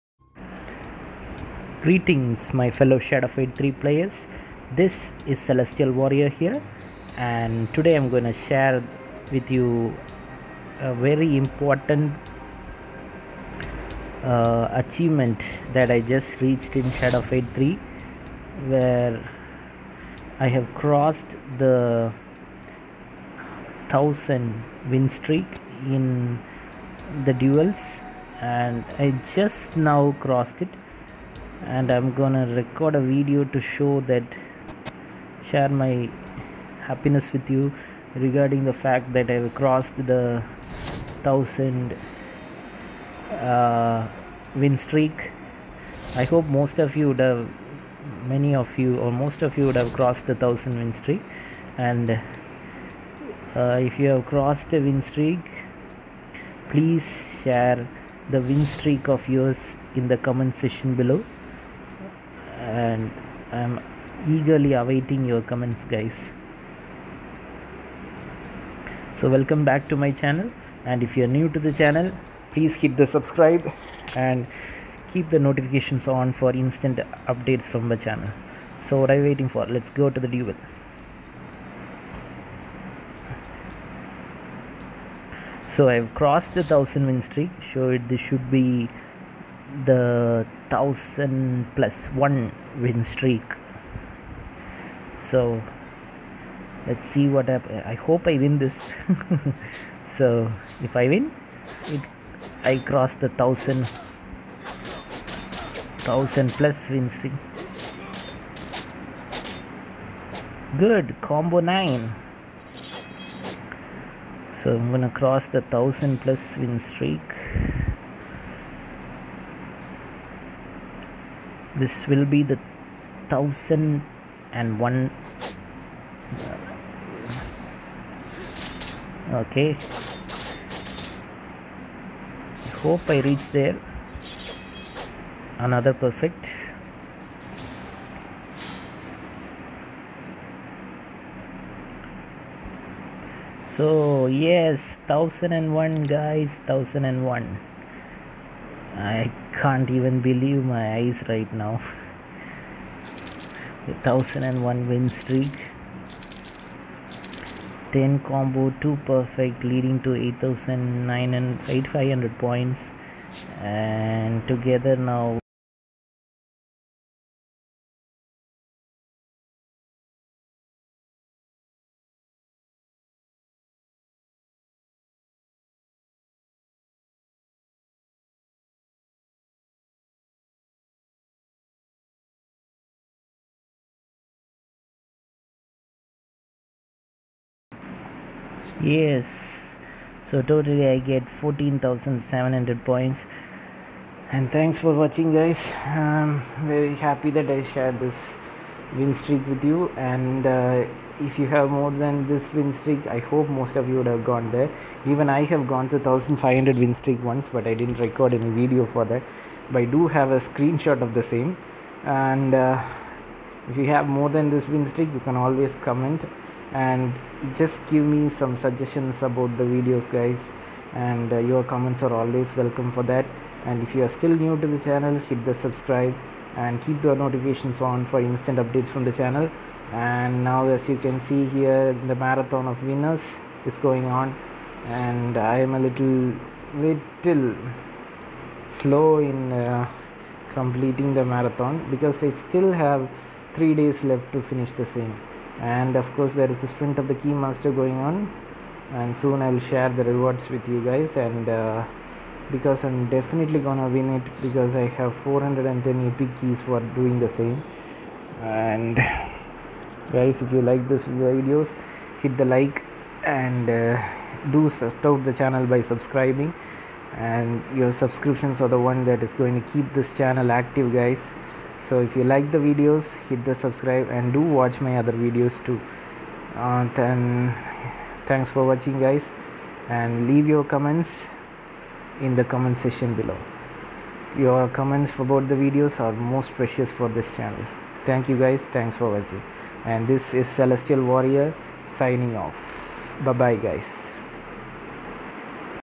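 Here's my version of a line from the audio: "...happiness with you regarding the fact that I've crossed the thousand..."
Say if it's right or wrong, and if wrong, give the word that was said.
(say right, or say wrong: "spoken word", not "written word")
right.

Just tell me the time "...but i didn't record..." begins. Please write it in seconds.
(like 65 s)
207 s.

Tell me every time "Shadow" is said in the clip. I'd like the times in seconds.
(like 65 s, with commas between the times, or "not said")
2 s, 16 s.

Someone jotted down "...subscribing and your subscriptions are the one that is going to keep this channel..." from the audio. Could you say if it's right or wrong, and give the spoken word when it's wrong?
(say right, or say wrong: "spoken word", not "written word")
right.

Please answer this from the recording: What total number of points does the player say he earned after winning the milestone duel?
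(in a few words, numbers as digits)
14700.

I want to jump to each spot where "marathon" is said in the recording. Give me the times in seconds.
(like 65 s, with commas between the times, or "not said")
232 s, 241 s.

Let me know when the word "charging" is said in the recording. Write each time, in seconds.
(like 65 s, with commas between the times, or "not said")
not said.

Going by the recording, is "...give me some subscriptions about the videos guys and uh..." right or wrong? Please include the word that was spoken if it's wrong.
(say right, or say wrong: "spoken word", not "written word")
wrong: "suggestions", not "subscriptions".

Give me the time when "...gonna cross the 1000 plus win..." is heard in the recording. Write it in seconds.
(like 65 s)
114 s.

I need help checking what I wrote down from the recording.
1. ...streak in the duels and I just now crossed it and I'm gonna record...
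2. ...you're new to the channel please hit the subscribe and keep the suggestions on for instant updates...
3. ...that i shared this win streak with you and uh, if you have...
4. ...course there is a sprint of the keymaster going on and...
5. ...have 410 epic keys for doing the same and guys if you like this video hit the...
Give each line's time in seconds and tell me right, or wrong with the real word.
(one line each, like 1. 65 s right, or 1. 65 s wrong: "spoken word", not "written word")
1. 25 s right
2. 71 s wrong: "notifications", not "suggestions"
3. 197 s right
4. 246 s right
5. 254 s right.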